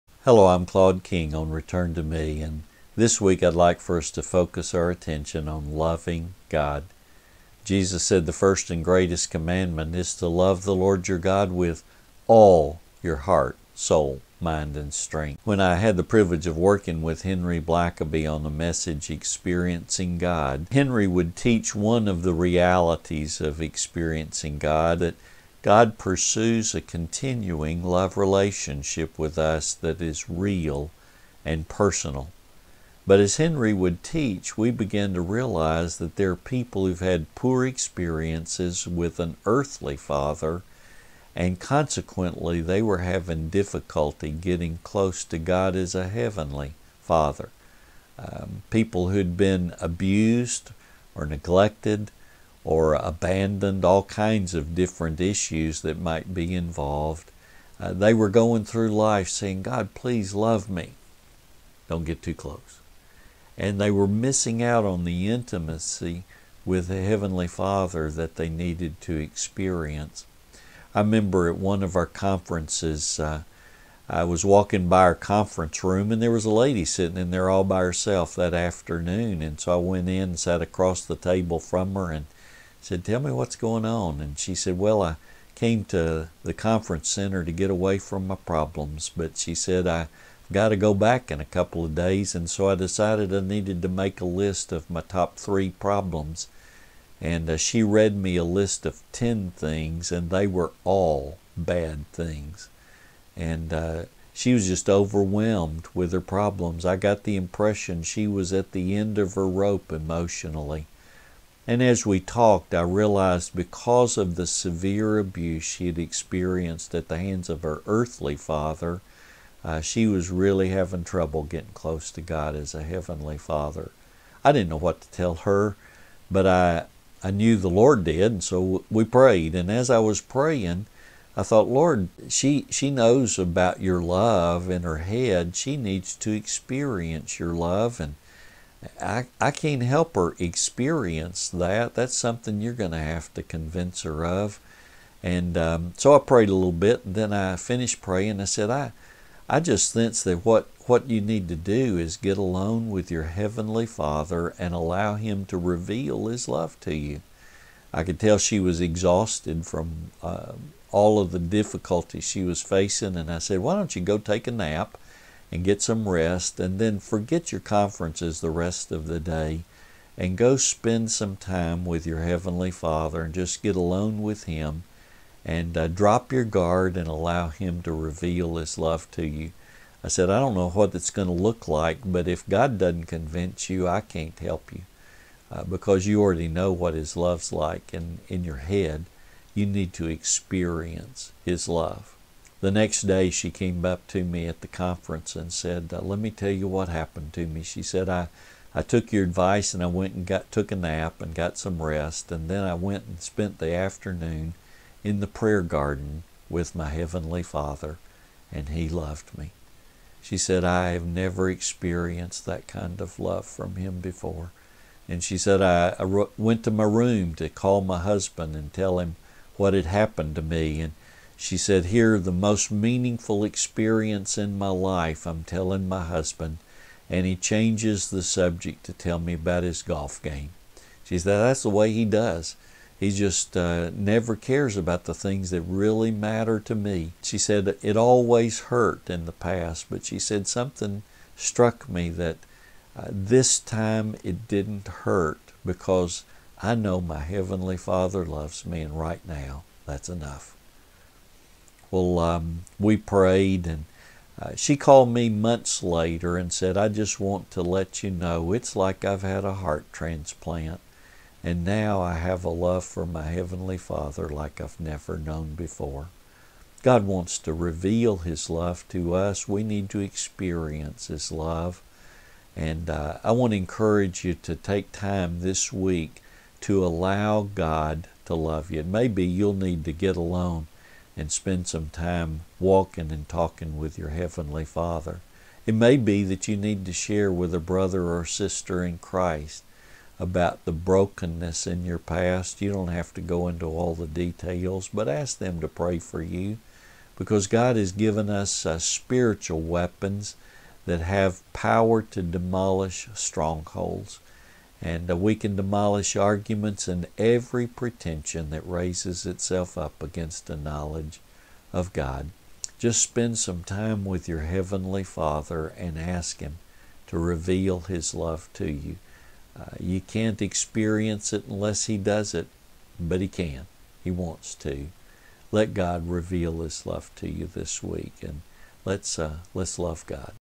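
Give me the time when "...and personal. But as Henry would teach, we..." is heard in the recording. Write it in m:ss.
0:31.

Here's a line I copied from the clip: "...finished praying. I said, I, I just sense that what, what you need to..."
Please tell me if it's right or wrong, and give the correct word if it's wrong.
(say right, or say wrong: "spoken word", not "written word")
right.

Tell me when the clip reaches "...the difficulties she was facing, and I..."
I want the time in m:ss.
2:41.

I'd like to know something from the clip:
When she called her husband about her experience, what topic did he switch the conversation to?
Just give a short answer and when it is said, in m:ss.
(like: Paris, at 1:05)
His golf game, at 3:49.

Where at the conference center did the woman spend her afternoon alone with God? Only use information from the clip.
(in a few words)
The prayer garden.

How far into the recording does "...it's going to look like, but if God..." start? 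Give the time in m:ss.
3:00.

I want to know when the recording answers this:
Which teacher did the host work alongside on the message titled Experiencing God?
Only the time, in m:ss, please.
0:17.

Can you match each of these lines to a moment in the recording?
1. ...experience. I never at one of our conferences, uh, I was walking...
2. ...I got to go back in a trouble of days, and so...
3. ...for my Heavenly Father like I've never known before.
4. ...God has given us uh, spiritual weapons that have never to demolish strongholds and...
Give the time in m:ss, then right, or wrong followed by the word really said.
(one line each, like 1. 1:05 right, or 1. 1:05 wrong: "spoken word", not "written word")
1. 1:09 wrong: "remember", not "never"
2. 1:29 wrong: "couple", not "trouble"
3. 4:22 right
4. 4:57 wrong: "power", not "never".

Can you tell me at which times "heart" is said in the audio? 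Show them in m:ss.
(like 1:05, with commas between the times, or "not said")
0:13, 4:19.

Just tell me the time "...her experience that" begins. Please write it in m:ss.
2:20.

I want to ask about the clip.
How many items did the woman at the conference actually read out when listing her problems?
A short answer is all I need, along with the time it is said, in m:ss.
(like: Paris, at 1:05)
10, at 1:39.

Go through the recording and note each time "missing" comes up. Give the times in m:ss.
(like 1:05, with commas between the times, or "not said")
1:04.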